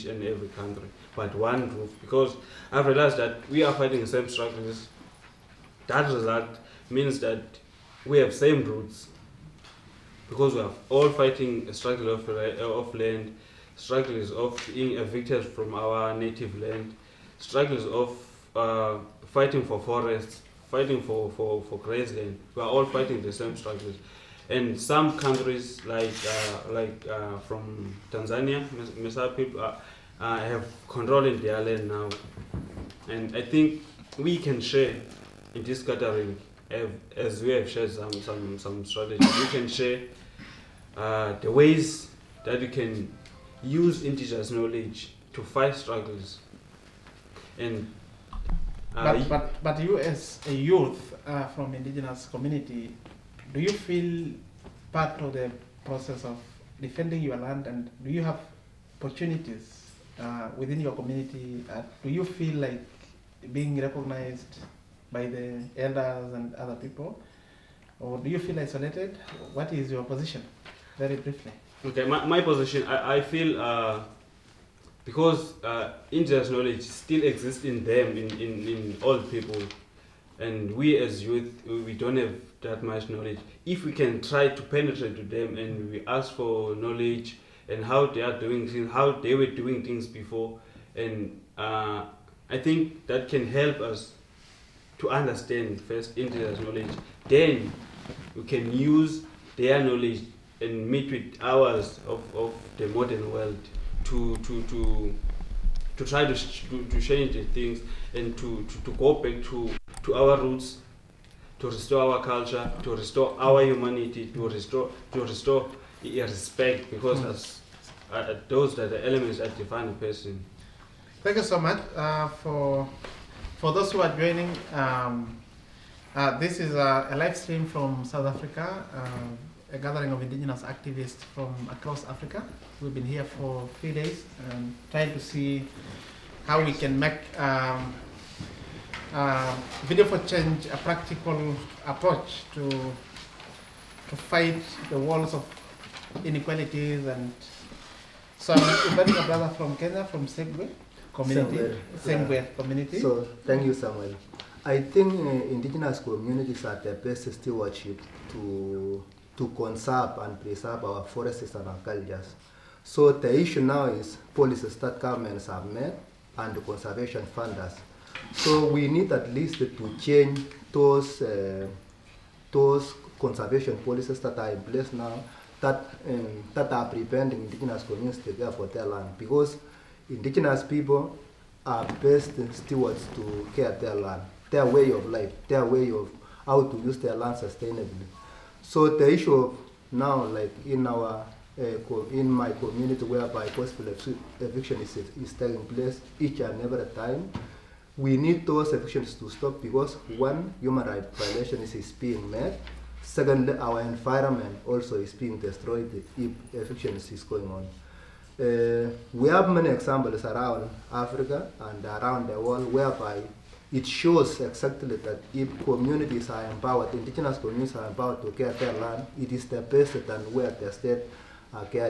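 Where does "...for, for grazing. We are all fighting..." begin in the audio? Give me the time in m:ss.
0:21.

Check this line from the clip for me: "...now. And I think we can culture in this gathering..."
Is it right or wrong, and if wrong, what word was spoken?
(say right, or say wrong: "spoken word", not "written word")
wrong: "share", not "culture".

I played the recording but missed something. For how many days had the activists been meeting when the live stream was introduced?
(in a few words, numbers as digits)
3.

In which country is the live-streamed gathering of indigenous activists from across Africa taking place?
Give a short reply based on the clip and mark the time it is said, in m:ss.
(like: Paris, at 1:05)
South Africa, at 2:08.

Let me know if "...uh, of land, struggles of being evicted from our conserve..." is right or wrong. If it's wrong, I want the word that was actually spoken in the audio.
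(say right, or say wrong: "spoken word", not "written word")
wrong: "native", not "conserve".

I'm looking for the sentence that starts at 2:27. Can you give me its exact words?
And so I'm inviting a brother from Kenya, from Sengwer community, Sengwer yeah.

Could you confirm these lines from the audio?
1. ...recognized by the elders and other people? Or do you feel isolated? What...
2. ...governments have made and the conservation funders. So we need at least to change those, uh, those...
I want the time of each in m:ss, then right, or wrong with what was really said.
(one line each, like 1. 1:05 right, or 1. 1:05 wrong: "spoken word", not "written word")
1. 1:03 right
2. 2:44 right.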